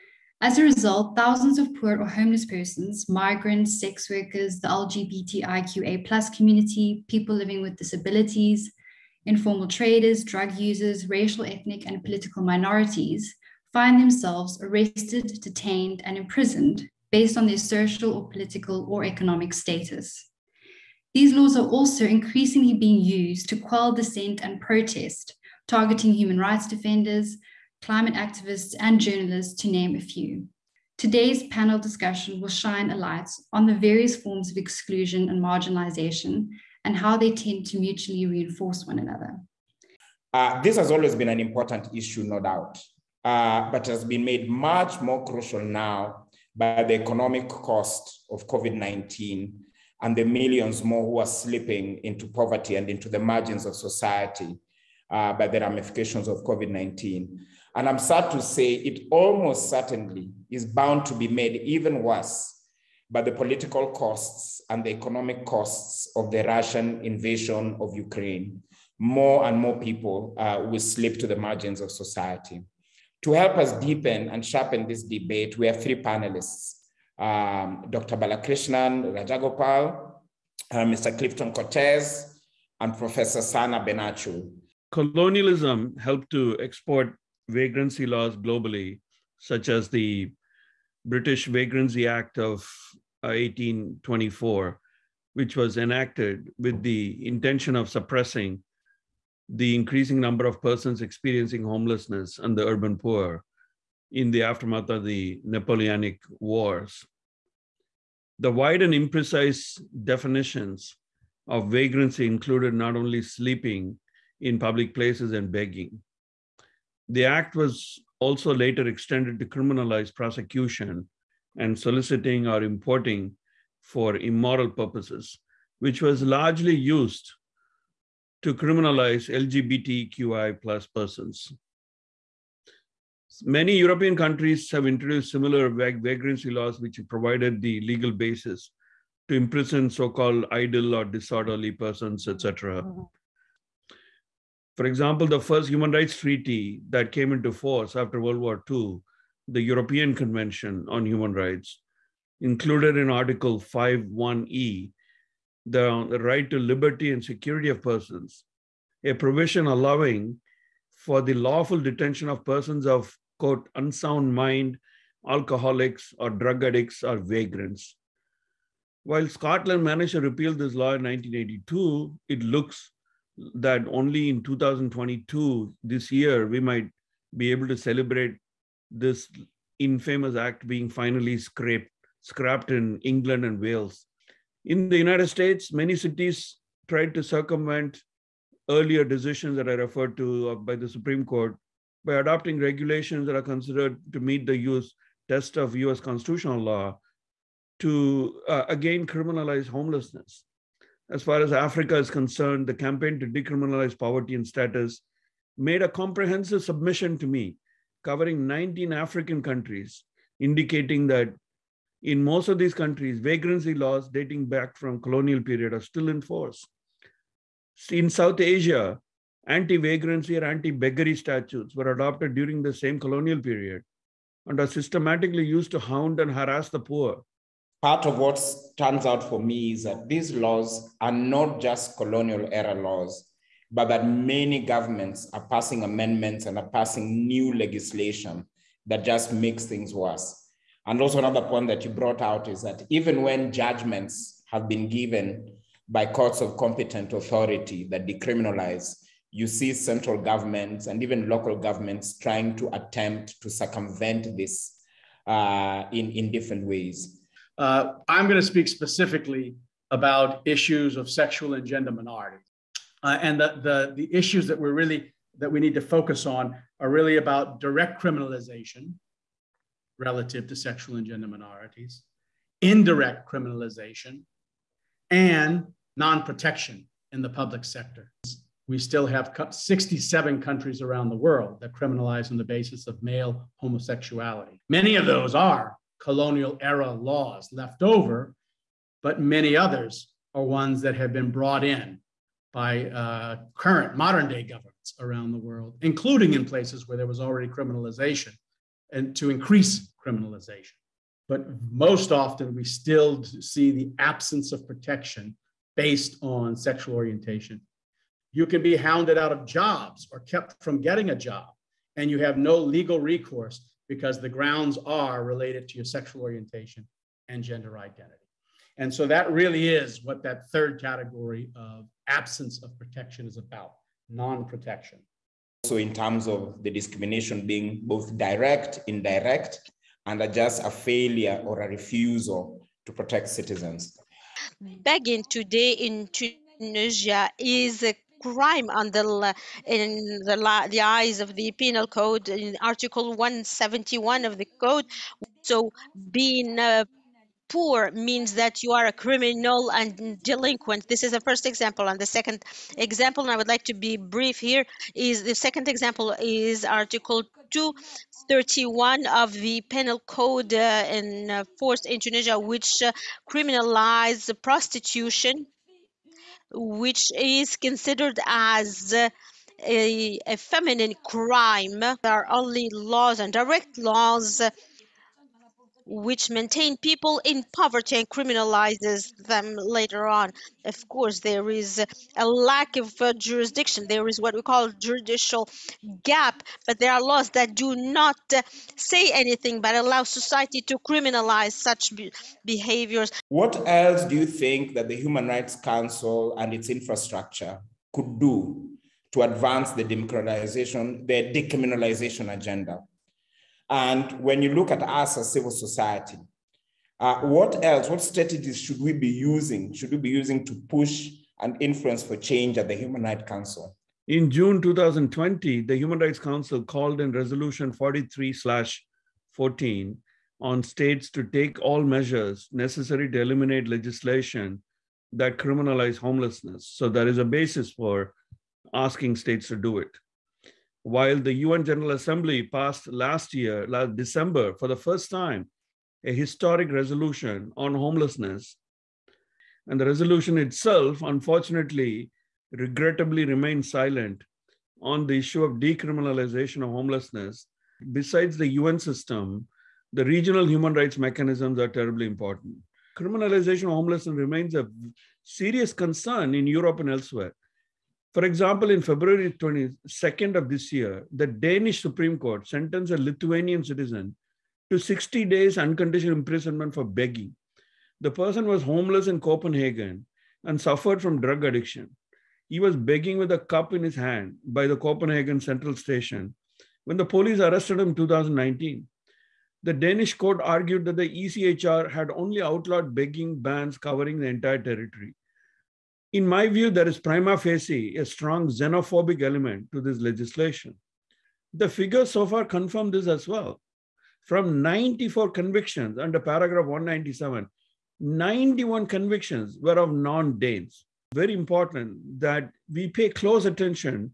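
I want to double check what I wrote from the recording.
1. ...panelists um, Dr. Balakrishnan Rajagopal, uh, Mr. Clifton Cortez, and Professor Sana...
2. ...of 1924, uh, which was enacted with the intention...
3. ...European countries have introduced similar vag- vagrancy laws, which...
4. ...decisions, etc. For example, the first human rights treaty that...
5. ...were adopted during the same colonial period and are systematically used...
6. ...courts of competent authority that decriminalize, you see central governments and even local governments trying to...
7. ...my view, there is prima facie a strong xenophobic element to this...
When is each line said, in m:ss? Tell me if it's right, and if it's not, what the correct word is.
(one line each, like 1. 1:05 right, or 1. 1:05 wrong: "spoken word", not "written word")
1. 1:16 right
2. 1:32 wrong: "1824", not "1924"
3. 2:13 right
4. 2:21 wrong: "persons", not "decisions"
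5. 3:41 right
6. 4:06 right
7. 8:06 right.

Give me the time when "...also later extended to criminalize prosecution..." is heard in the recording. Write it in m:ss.
1:58.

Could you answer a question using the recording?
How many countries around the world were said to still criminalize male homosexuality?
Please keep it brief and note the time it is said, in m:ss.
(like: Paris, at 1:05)
67, at 4:39.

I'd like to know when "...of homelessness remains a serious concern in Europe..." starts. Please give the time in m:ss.
7:33.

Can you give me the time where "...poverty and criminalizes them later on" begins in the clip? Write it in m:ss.
6:17.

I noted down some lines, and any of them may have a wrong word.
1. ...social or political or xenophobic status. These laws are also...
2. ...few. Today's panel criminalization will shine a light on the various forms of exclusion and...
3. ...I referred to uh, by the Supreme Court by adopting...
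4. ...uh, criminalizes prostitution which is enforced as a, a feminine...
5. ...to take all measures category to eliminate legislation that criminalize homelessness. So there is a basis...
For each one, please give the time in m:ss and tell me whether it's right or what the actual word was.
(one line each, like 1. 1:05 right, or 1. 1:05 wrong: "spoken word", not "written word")
1. 0:17 wrong: "economic", not "xenophobic"
2. 0:30 wrong: "discussion", not "criminalization"
3. 3:09 right
4. 6:02 wrong: "considered", not "enforced"
5. 7:01 wrong: "necessary", not "category".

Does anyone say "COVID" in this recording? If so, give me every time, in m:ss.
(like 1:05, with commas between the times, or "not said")
0:48, 0:56.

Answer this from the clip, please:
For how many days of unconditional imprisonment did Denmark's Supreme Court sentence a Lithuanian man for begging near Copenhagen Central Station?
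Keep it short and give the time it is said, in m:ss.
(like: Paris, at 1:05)
60 days, at 7:44.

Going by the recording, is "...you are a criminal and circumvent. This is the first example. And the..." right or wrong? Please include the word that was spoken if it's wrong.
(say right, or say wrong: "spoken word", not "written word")
wrong: "delinquent", not "circumvent".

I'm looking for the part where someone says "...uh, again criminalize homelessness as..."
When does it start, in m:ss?
3:18.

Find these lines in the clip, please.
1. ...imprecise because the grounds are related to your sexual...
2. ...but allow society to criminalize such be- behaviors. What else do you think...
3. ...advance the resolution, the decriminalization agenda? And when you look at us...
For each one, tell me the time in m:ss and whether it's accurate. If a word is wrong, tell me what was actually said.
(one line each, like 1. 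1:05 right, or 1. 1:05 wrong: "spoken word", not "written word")
1. 5:13 wrong: "recourse", not "imprecise"
2. 6:29 right
3. 6:39 wrong: "democratization", not "resolution".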